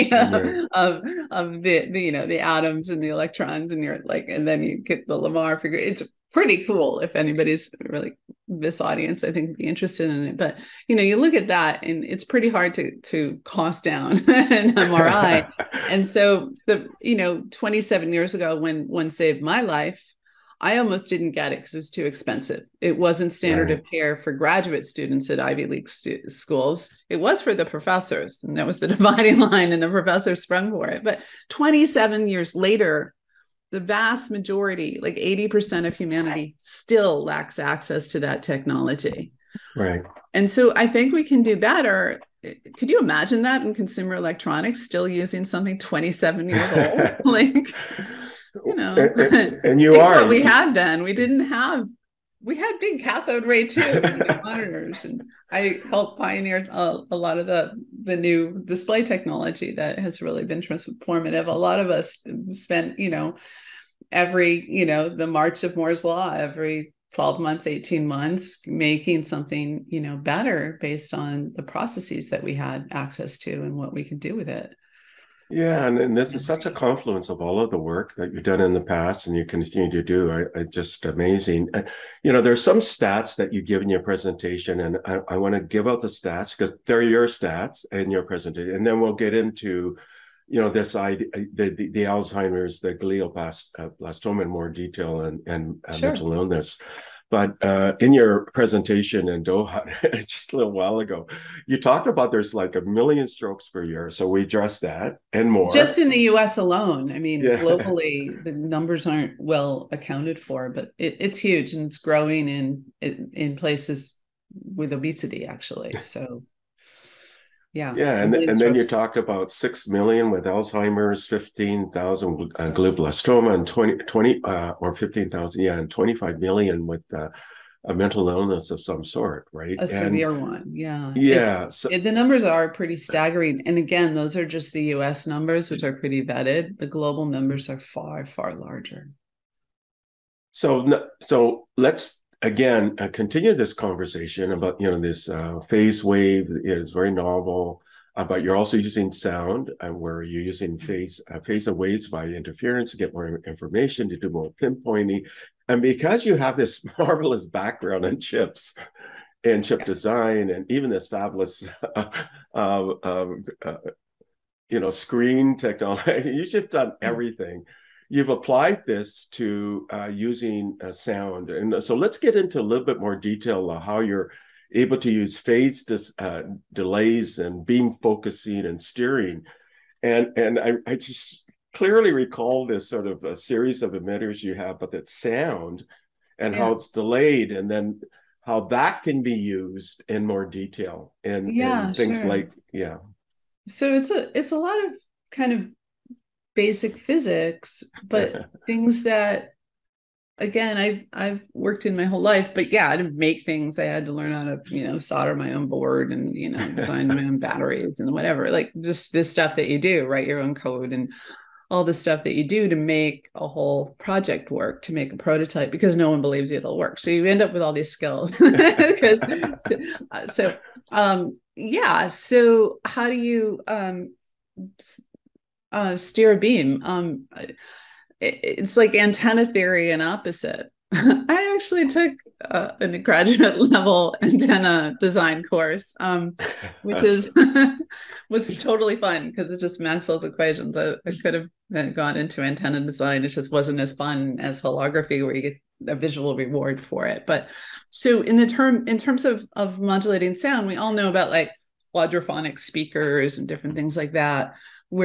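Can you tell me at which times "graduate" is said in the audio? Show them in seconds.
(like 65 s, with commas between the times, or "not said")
24 s, 232 s.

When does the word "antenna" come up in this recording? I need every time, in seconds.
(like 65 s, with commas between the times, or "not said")
228 s, 234 s, 242 s.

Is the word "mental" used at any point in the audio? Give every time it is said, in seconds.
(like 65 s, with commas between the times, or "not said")
96 s, 127 s.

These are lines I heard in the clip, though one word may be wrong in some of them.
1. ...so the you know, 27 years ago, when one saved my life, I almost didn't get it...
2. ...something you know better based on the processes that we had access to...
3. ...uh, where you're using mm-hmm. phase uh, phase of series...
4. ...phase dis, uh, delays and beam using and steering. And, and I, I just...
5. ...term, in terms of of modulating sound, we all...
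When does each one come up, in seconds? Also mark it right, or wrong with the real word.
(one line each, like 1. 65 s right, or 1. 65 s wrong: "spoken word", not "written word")
1. 16 s right
2. 69 s right
3. 149 s wrong: "waves", not "series"
4. 175 s wrong: "focusing", not "using"
5. 248 s right.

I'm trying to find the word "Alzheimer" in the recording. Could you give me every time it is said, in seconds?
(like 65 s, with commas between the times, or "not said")
92 s, 120 s.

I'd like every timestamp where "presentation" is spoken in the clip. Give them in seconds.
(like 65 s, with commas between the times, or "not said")
84 s, 88 s, 98 s.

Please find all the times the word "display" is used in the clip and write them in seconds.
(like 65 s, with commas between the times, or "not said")
58 s.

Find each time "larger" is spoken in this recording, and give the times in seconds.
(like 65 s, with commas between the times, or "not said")
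138 s.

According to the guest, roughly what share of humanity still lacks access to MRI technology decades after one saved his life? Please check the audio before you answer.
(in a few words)
80%.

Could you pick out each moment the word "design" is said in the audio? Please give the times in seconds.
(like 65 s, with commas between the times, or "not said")
159 s, 206 s, 234 s, 242 s.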